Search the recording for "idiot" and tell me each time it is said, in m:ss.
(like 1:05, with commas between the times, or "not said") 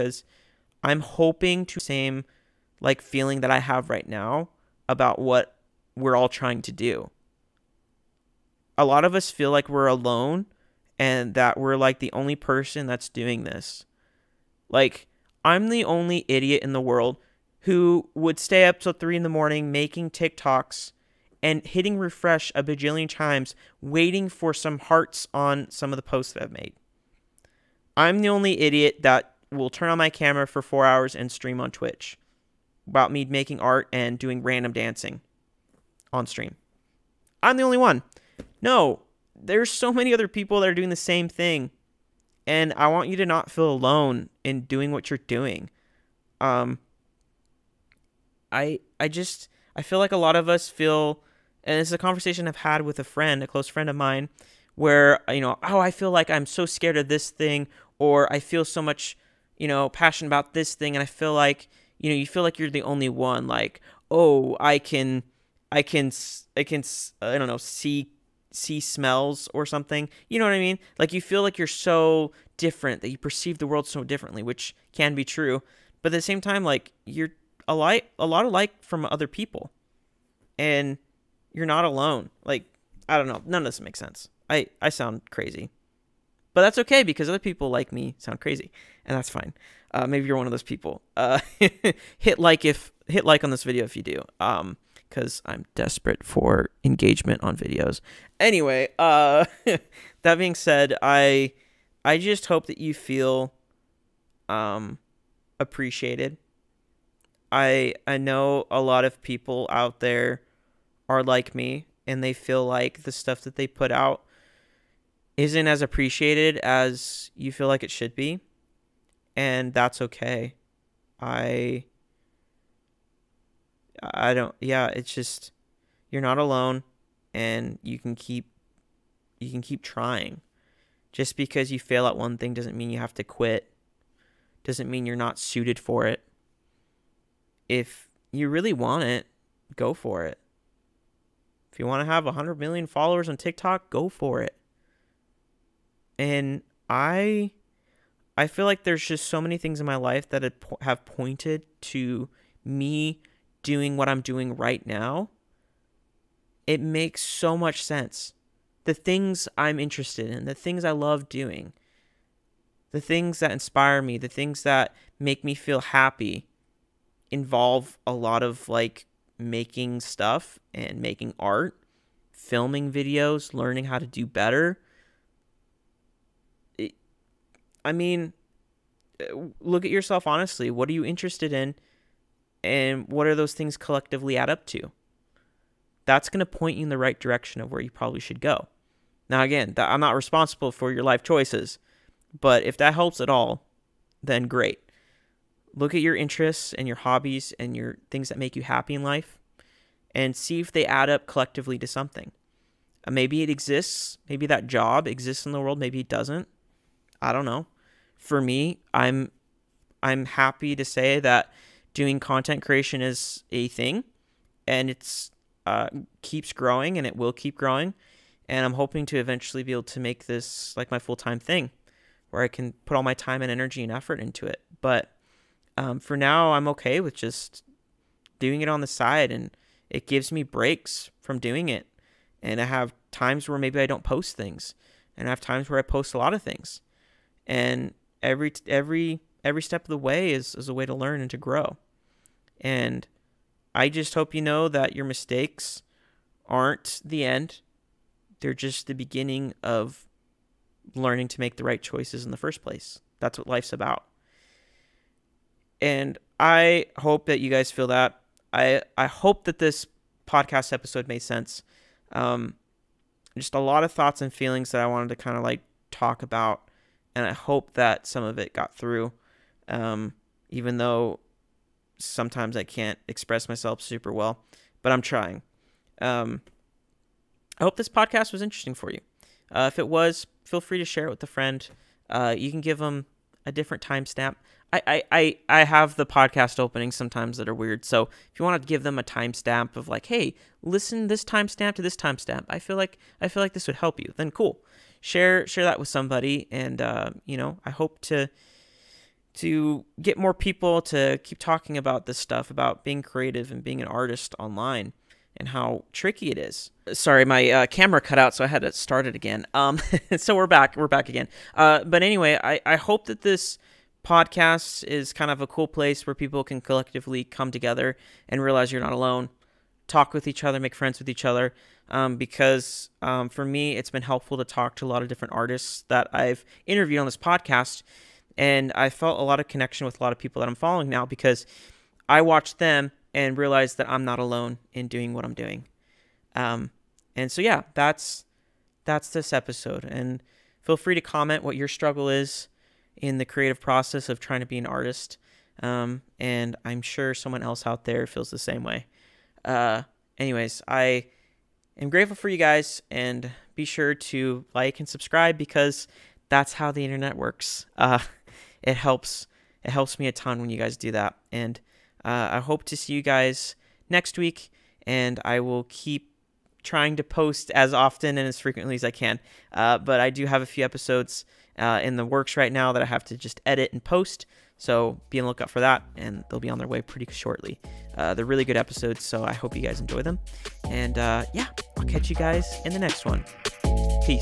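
0:16, 0:28.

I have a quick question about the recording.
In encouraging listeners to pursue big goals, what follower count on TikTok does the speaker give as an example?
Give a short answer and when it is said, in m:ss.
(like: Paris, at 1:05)
100 million, at 2:22.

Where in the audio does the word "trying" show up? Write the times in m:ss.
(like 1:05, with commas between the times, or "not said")
0:06, 2:09, 4:35, 5:44, 6:06.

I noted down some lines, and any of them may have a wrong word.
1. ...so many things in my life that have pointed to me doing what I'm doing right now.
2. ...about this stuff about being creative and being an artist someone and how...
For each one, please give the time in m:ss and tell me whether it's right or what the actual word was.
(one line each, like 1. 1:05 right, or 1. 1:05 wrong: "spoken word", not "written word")
1. 2:29 right
2. 5:01 wrong: "online", not "someone".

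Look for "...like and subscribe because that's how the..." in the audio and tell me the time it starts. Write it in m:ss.
5:54.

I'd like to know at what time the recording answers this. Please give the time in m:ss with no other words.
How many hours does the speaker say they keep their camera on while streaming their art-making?
0:30.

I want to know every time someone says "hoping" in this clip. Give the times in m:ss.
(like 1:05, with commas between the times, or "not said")
0:01, 3:38.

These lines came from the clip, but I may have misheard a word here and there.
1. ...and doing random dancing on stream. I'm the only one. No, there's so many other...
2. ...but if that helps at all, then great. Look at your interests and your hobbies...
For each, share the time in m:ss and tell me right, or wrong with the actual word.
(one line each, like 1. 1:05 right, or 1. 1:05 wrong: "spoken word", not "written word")
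1. 0:33 right
2. 3:12 right.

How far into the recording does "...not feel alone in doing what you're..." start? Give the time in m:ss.
0:43.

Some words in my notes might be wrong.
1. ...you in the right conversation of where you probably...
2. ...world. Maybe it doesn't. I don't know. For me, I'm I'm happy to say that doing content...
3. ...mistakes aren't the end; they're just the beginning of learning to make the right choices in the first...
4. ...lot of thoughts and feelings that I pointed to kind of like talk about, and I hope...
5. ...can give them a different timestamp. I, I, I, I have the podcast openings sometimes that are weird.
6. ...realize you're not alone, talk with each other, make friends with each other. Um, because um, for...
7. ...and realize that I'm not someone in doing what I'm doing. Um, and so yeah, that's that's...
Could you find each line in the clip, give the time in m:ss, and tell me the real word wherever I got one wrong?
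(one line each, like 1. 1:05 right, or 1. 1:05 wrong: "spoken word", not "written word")
1. 3:06 wrong: "direction", not "conversation"
2. 3:25 right
3. 4:05 right
4. 4:23 wrong: "wanted", not "pointed"
5. 4:42 right
6. 5:18 right
7. 5:33 wrong: "alone", not "someone".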